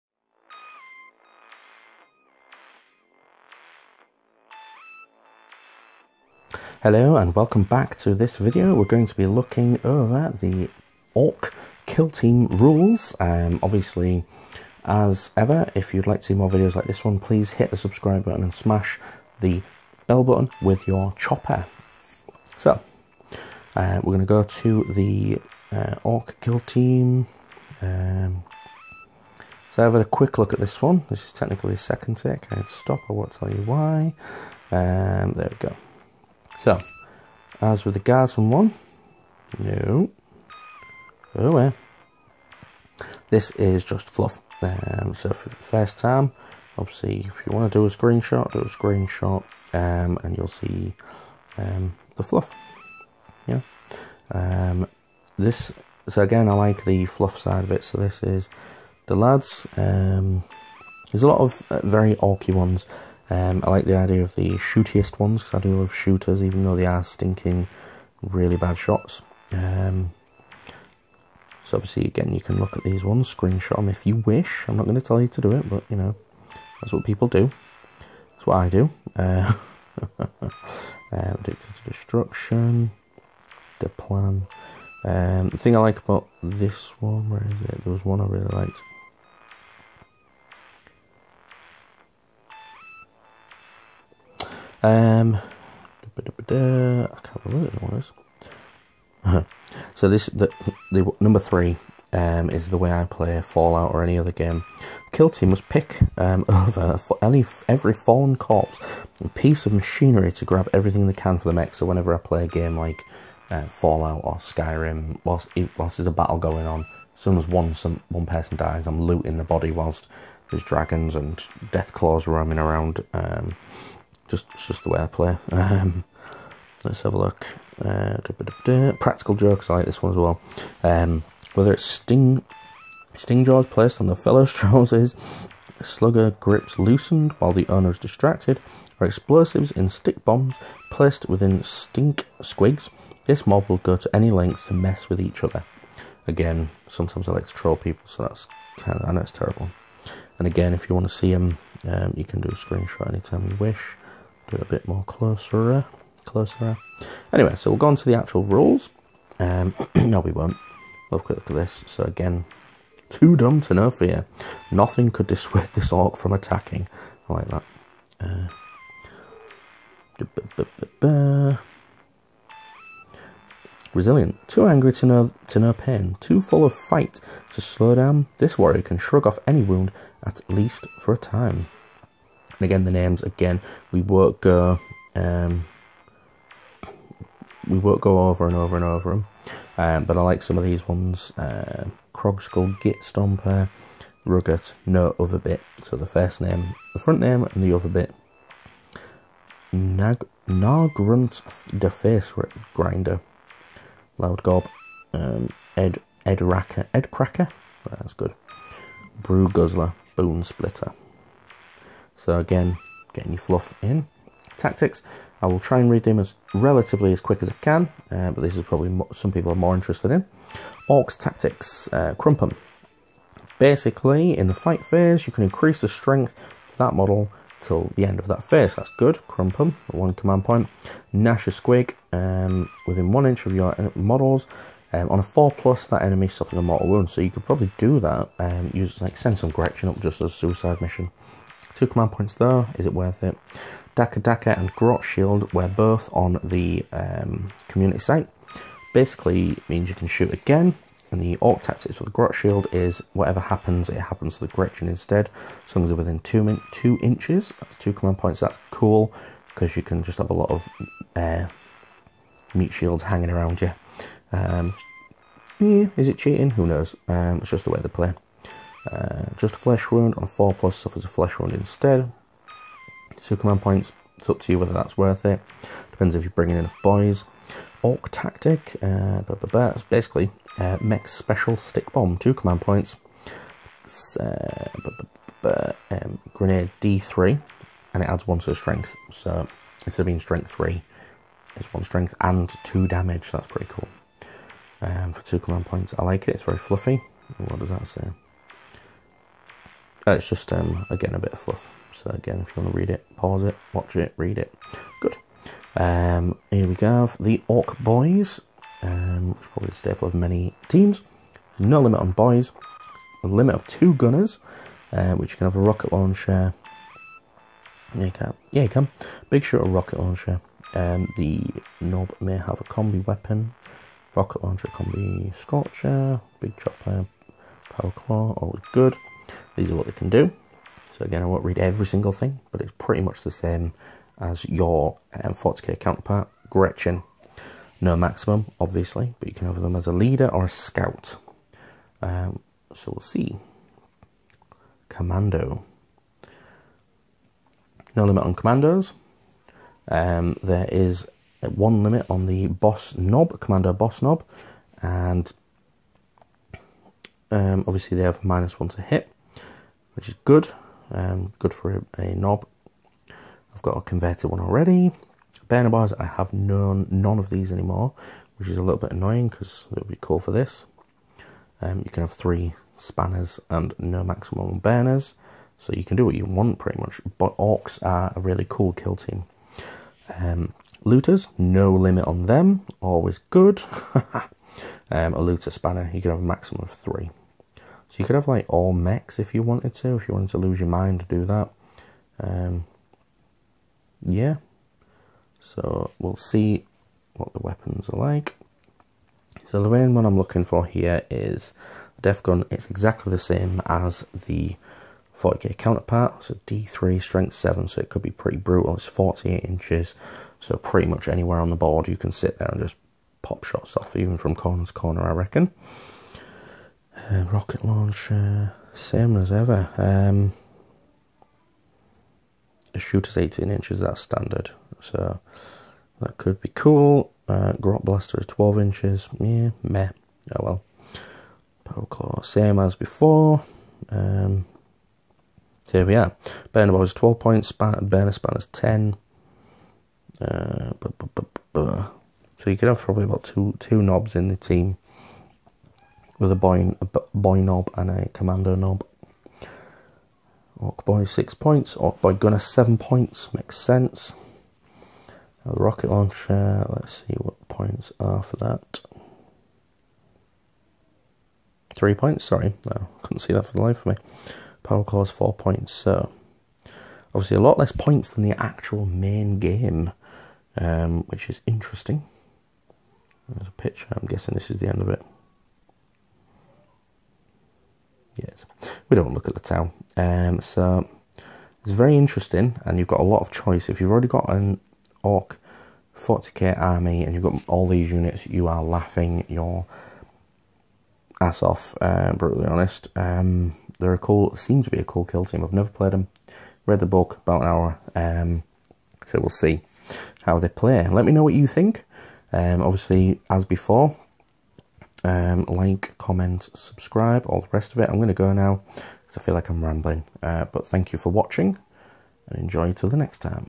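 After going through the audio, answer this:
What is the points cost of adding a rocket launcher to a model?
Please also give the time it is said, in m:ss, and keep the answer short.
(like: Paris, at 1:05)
3 points, at 7:41.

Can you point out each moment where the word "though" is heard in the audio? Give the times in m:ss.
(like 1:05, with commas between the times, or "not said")
1:06, 4:02.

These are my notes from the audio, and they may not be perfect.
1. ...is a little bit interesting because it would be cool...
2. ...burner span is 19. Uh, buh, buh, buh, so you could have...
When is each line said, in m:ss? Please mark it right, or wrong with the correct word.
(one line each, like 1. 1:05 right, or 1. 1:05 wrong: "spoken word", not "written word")
1. 6:08 wrong: "annoying", not "interesting"
2. 7:17 wrong: "10", not "19".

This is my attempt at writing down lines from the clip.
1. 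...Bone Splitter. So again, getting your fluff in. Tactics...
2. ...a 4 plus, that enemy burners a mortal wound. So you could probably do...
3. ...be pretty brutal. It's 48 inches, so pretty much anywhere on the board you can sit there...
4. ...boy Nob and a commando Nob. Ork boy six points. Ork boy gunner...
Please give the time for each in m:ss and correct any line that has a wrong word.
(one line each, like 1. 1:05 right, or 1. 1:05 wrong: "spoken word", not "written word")
1. 3:30 right
2. 3:55 wrong: "suffers", not "burners"
3. 6:48 right
4. 7:27 right.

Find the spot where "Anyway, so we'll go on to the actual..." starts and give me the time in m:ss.
2:37.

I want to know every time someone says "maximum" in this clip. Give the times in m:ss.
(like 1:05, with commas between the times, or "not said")
5:37, 6:14, 6:26.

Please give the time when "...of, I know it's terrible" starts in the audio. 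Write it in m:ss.
2:29.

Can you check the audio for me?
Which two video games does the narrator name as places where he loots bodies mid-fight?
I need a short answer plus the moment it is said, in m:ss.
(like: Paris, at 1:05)
Fallout or Skyrim, at 1:53.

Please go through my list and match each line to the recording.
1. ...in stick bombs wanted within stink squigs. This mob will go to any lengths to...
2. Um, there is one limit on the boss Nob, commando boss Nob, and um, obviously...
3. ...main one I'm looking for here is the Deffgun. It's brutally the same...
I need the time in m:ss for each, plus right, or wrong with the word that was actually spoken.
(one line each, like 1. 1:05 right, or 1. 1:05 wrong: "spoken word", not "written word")
1. 2:19 wrong: "placed", not "wanted"
2. 5:49 right
3. 6:39 wrong: "exactly", not "brutally".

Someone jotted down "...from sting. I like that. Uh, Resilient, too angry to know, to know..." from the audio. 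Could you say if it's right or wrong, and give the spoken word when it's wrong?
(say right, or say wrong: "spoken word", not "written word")
wrong: "attacking", not "sting".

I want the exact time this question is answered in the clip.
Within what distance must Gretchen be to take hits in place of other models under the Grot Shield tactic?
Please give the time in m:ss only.
4:16.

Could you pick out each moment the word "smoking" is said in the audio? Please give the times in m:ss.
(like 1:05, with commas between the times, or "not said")
not said.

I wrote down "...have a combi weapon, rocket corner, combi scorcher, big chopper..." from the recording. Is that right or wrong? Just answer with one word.
wrong.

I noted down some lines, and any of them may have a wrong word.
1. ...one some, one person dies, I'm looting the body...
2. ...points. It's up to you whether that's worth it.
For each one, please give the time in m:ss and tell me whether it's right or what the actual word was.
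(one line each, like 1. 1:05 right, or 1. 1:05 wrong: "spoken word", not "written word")
1. 1:57 right
2. 4:33 right.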